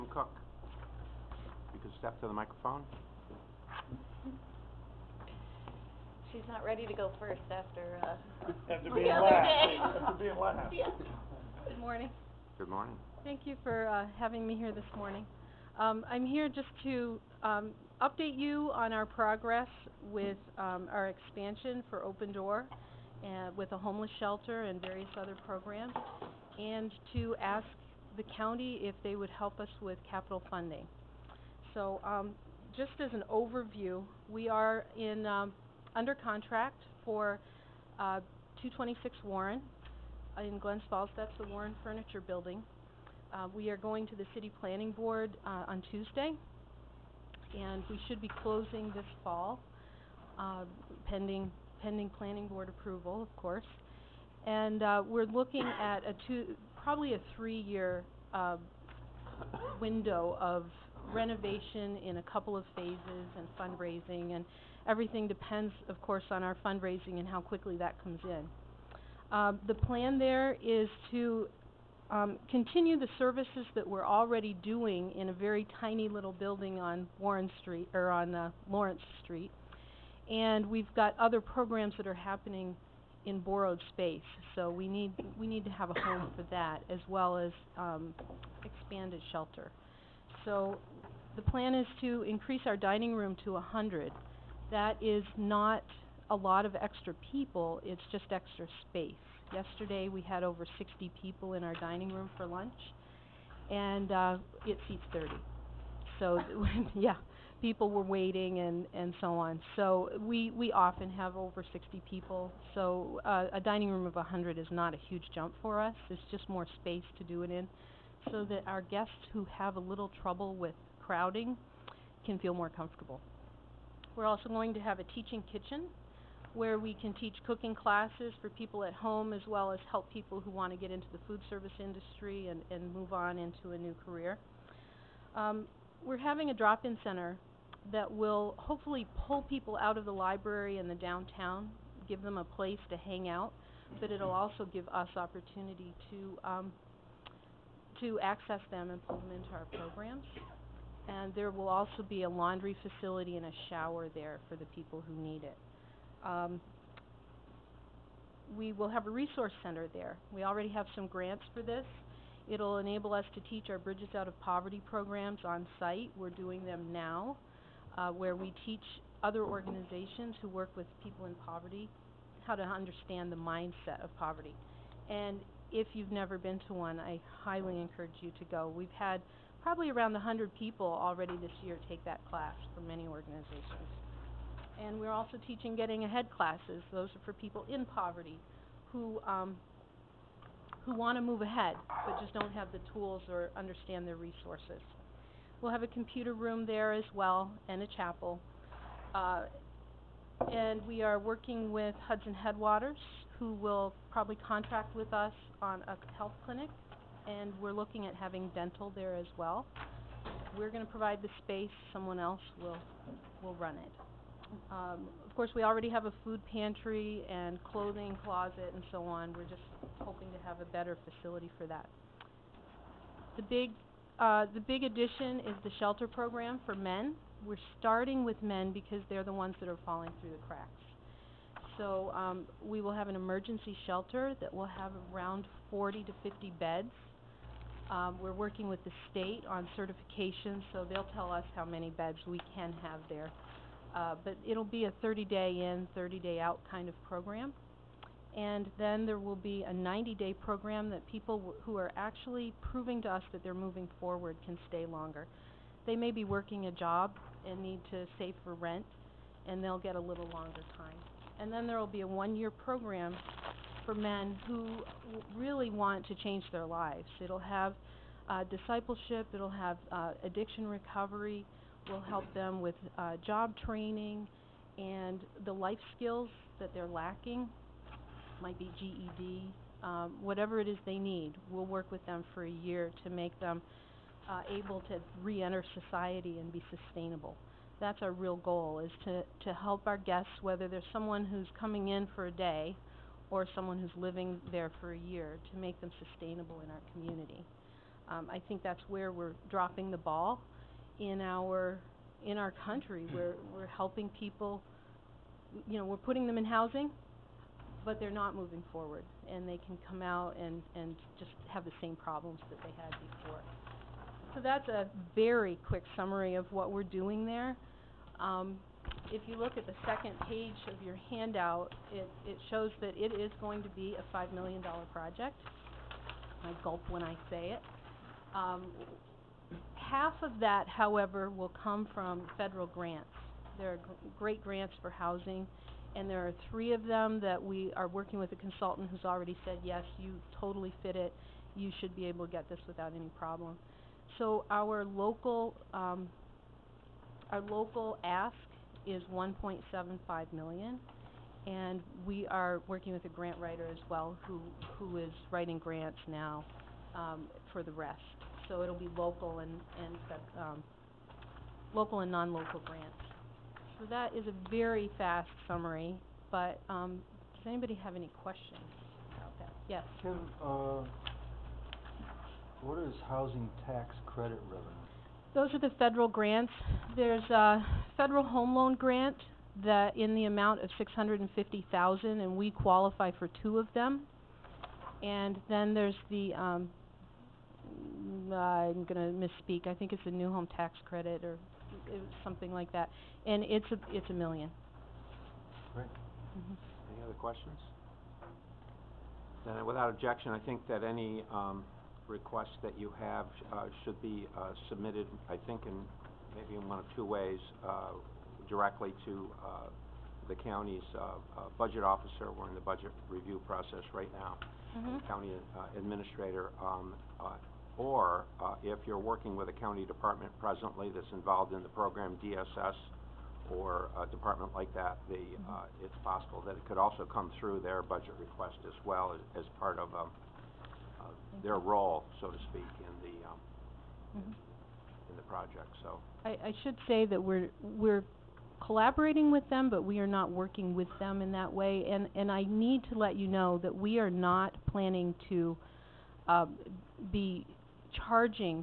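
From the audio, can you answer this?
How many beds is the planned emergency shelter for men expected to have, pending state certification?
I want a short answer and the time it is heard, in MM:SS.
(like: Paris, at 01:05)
40 to 50, at 03:55.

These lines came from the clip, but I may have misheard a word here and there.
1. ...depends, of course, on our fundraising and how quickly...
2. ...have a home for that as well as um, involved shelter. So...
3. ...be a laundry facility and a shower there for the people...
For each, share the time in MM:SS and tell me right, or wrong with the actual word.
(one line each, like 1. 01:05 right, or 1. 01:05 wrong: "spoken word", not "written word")
1. 01:05 right
2. 01:25 wrong: "expanded", not "involved"
3. 02:32 right.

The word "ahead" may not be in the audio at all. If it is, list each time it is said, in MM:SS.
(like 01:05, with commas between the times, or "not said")
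03:06, 03:11.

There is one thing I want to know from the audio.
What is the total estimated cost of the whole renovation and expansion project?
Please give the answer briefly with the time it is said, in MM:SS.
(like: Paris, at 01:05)
$5 million, at 05:24.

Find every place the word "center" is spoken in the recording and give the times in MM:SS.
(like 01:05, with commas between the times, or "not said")
02:17, 02:39.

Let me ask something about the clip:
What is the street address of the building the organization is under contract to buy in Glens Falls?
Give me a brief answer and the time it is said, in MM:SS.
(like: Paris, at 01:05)
226 Warren, at 00:38.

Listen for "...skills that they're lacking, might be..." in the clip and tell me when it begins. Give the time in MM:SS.
04:35.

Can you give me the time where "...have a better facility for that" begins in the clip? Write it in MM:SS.
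03:40.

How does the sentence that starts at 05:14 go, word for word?
So that's a very quick summary of what we're doing there.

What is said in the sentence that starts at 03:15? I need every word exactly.
We'll have a computer room there as well and a chapel.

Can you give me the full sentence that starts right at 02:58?
We've had probably around 100 people already this year take that class for many organizations.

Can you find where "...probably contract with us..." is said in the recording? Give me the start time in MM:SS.
03:24.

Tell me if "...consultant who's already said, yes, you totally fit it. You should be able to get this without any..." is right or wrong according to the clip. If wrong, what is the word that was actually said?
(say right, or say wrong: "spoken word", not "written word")
right.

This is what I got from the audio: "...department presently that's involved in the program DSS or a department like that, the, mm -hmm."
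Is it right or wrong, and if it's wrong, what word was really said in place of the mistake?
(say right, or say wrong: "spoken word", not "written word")
right.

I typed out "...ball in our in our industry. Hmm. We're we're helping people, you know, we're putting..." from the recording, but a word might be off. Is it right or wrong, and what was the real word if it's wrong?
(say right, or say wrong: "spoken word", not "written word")
wrong: "country", not "industry".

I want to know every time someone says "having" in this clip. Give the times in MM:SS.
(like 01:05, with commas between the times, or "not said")
00:14, 02:16, 03:28.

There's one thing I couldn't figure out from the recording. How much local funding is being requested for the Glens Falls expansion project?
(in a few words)
1.75 million.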